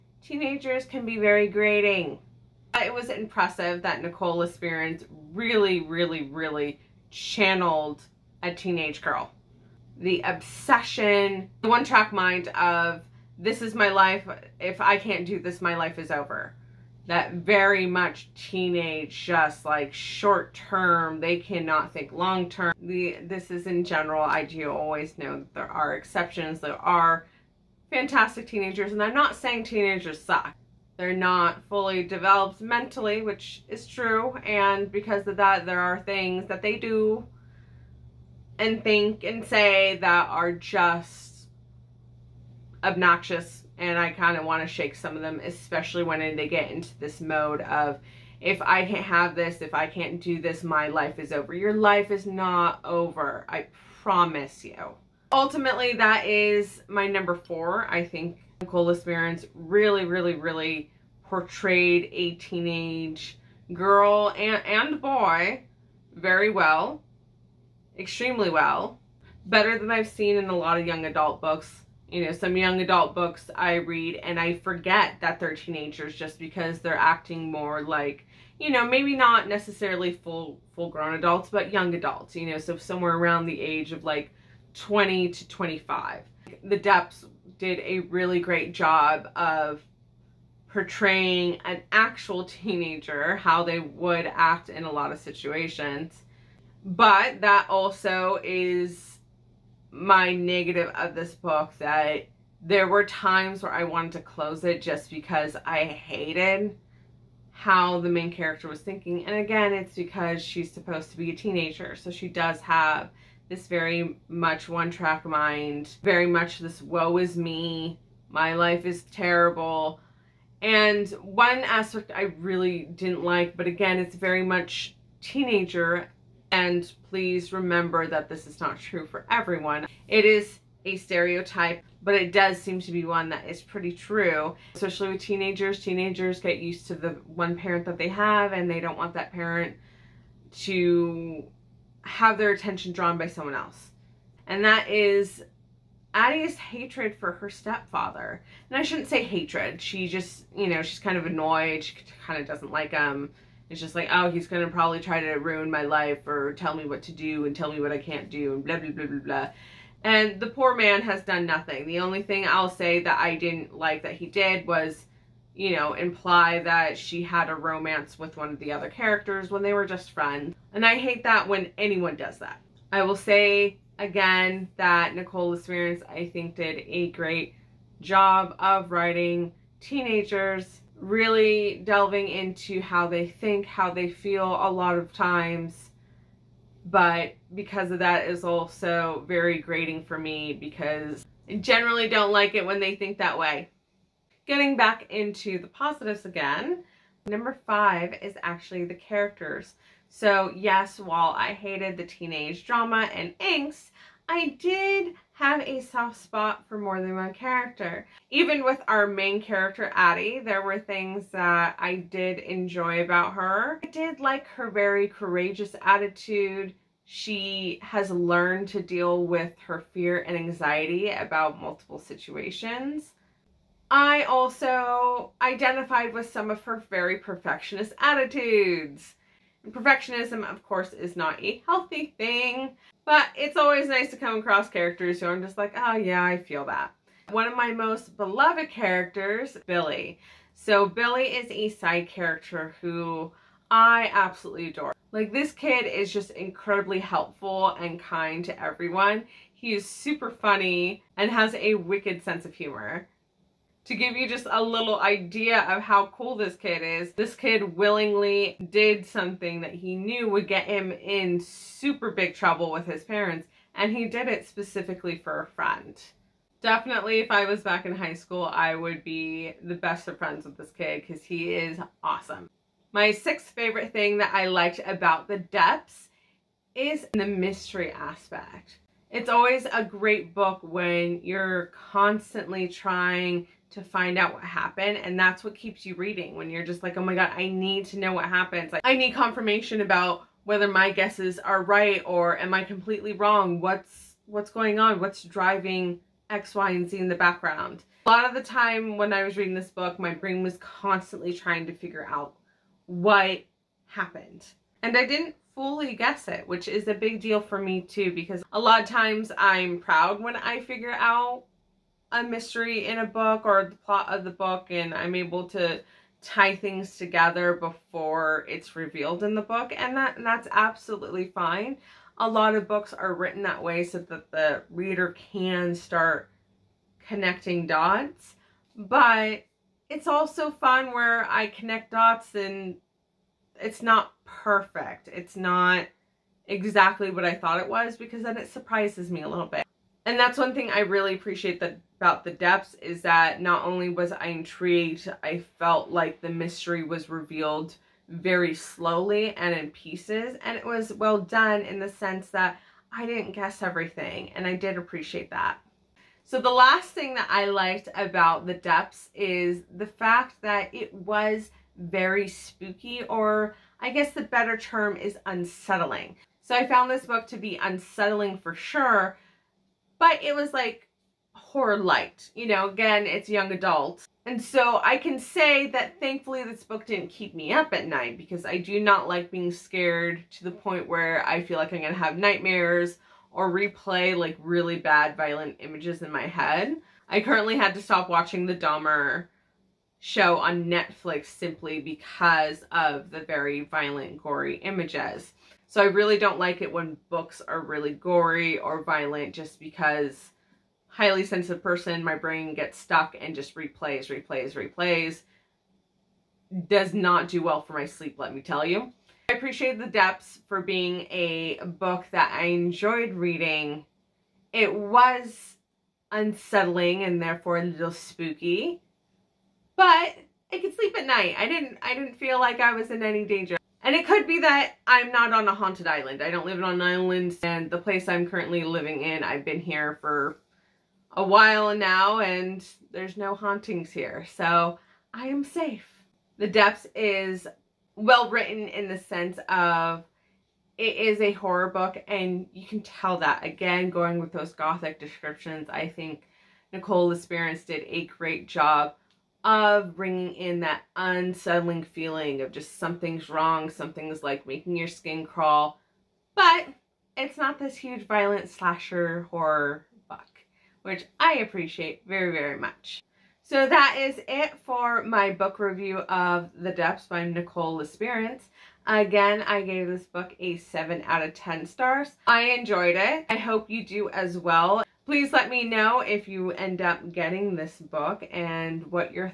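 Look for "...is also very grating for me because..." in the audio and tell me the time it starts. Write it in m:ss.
3:08.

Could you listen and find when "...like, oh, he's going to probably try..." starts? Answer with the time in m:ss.
2:33.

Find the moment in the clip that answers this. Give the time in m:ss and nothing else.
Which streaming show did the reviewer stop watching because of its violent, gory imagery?
6:28.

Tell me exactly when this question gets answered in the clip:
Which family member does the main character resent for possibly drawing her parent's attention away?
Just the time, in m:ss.
2:27.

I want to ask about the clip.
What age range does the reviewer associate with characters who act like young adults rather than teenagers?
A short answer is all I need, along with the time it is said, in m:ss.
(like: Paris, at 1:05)
20 to 25, at 1:24.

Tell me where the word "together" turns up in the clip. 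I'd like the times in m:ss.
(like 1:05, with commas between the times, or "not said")
5:16.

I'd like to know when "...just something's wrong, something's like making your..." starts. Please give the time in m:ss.
7:32.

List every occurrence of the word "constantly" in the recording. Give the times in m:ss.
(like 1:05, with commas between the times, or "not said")
4:41, 5:00.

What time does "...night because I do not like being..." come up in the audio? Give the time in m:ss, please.
6:17.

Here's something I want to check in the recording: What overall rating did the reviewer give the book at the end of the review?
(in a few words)
7 out of 10.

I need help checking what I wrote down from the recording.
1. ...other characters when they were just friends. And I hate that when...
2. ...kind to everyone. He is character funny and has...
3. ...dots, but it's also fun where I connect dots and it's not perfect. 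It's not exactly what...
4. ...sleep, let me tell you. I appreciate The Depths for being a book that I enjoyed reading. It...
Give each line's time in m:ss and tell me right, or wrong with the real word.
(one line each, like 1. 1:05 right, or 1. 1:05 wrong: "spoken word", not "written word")
1. 2:48 right
2. 4:07 wrong: "super", not "character"
3. 5:27 right
4. 6:47 right.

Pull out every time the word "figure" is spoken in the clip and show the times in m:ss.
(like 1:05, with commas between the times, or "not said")
5:01, 5:10.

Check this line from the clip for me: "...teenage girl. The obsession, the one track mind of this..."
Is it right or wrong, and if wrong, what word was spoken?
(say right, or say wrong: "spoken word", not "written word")
right.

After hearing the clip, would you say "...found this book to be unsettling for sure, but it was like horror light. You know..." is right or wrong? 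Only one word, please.
right.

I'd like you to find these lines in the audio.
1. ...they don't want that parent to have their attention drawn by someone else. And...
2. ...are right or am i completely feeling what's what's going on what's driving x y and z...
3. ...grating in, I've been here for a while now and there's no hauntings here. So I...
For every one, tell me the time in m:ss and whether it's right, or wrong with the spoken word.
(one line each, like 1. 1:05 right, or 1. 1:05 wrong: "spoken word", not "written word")
1. 2:18 right
2. 4:51 wrong: "wrong", not "feeling"
3. 7:08 wrong: "living", not "grating".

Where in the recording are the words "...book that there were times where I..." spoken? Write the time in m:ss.
1:41.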